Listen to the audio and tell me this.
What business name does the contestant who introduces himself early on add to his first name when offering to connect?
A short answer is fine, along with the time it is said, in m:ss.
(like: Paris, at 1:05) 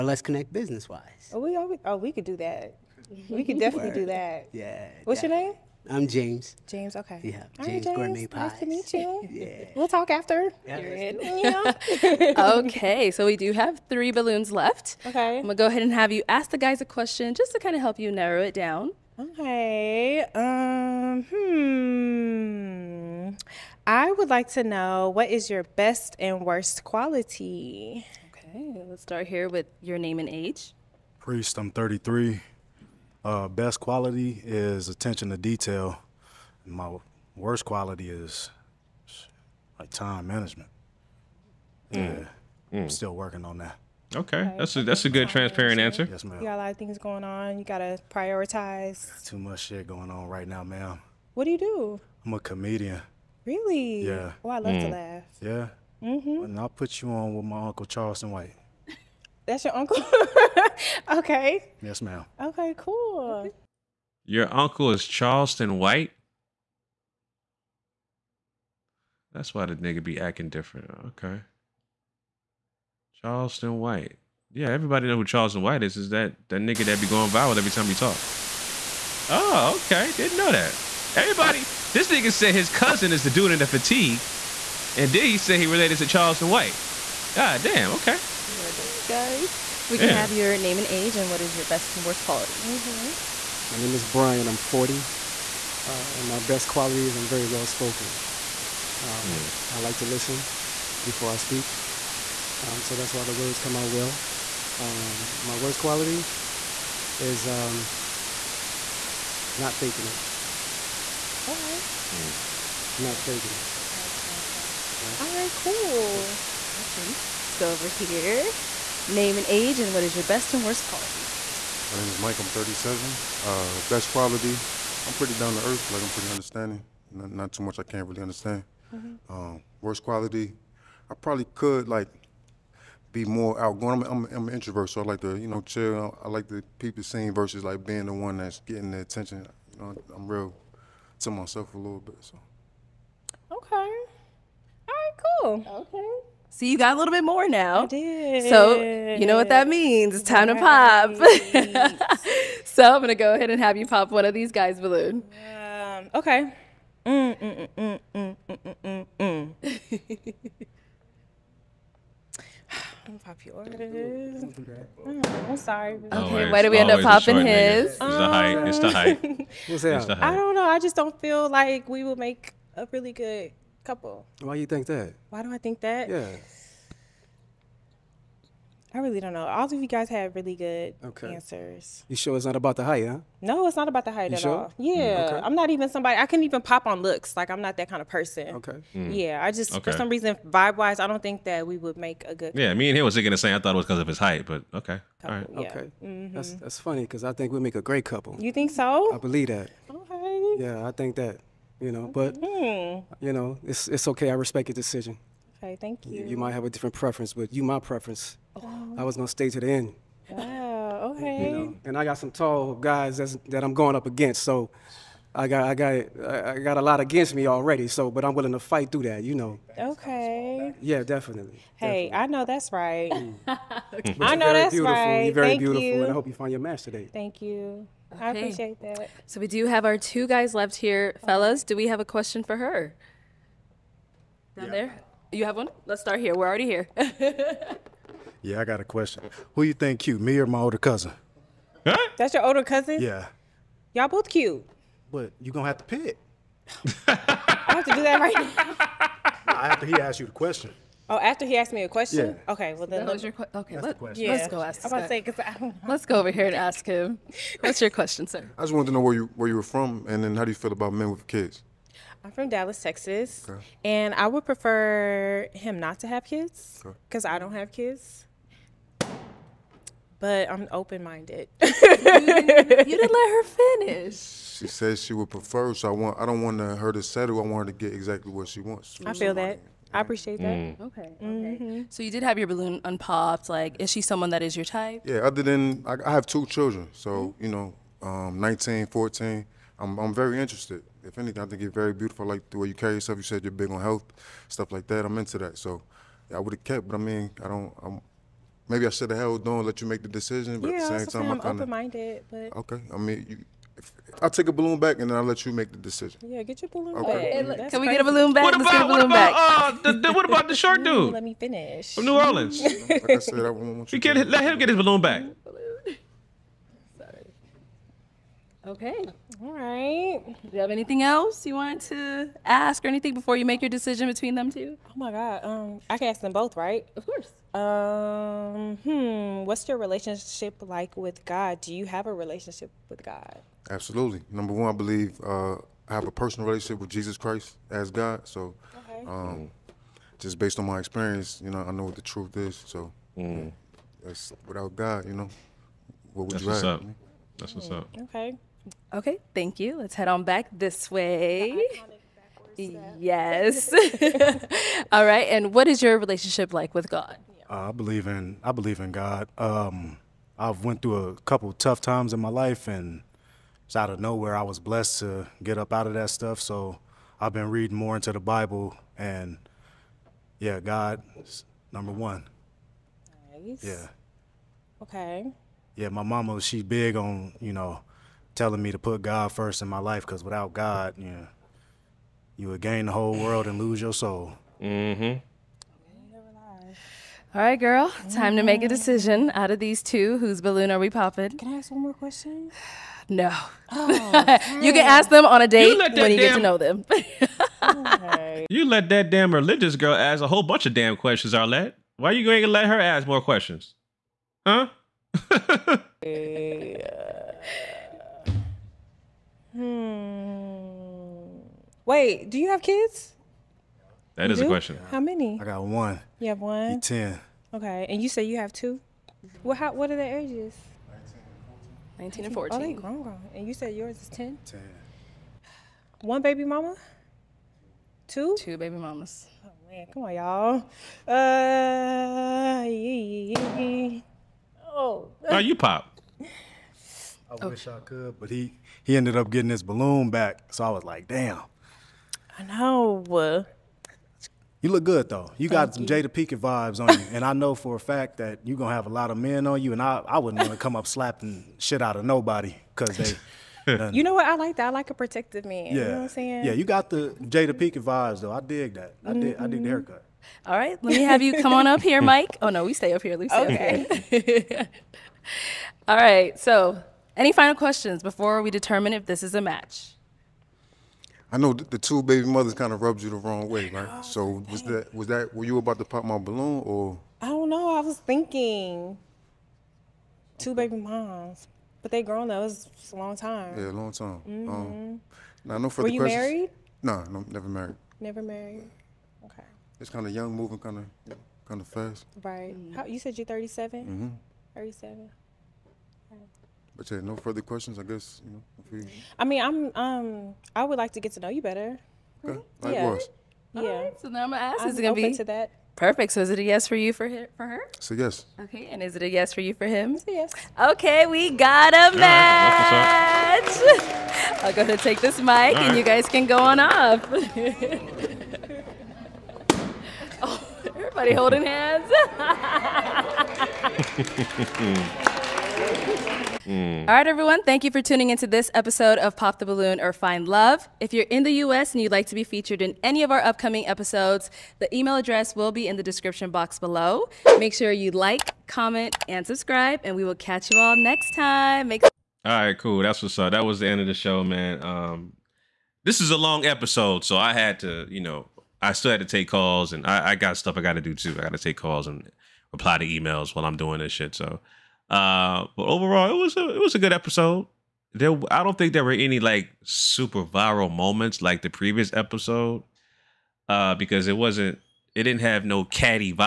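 Gourmet Pies, at 0:07.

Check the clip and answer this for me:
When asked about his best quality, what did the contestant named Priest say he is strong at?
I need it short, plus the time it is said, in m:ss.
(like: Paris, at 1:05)
Attention to detail, at 0:34.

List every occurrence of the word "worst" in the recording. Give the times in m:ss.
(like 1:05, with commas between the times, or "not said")
0:26, 0:37, 1:32, 1:45, 2:00, 2:09.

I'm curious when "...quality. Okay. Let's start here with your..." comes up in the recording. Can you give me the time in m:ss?
0:26.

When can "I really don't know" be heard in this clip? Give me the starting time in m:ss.
2:58.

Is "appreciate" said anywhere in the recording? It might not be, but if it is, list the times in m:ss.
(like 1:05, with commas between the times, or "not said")
3:48, 4:39.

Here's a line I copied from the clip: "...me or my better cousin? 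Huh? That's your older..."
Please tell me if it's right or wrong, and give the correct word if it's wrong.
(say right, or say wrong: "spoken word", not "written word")
wrong: "older", not "better".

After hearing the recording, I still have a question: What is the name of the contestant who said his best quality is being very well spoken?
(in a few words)
Brian.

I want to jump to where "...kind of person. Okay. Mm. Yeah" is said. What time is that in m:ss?
3:07.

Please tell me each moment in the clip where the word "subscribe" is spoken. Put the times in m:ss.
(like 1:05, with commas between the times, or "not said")
8:59.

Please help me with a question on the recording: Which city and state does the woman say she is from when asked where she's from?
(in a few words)
Dallas, Texas.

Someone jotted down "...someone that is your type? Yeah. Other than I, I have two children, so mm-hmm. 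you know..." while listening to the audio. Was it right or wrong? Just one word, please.
right.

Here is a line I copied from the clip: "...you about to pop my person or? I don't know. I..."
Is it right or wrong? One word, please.
wrong.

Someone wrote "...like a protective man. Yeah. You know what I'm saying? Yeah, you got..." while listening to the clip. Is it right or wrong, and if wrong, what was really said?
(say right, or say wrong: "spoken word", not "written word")
right.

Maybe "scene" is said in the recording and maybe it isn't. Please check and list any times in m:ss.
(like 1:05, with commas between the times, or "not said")
2:17.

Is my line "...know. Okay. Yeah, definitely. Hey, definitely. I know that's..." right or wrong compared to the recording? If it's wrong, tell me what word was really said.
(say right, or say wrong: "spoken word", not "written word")
right.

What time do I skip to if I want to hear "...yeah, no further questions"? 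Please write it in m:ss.
8:16.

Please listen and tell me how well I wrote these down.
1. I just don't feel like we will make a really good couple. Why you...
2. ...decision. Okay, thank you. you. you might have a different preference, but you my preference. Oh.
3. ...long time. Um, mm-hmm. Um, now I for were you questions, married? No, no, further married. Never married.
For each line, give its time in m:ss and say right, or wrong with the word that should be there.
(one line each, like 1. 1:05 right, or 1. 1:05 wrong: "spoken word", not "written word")
1. 2:50 right
2. 3:24 right
3. 8:03 wrong: "never", not "further".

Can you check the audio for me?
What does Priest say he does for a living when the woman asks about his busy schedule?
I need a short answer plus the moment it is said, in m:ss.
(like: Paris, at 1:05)
Comedian, at 0:52.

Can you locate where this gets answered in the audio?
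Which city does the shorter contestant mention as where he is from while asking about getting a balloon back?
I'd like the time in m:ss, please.
5:12.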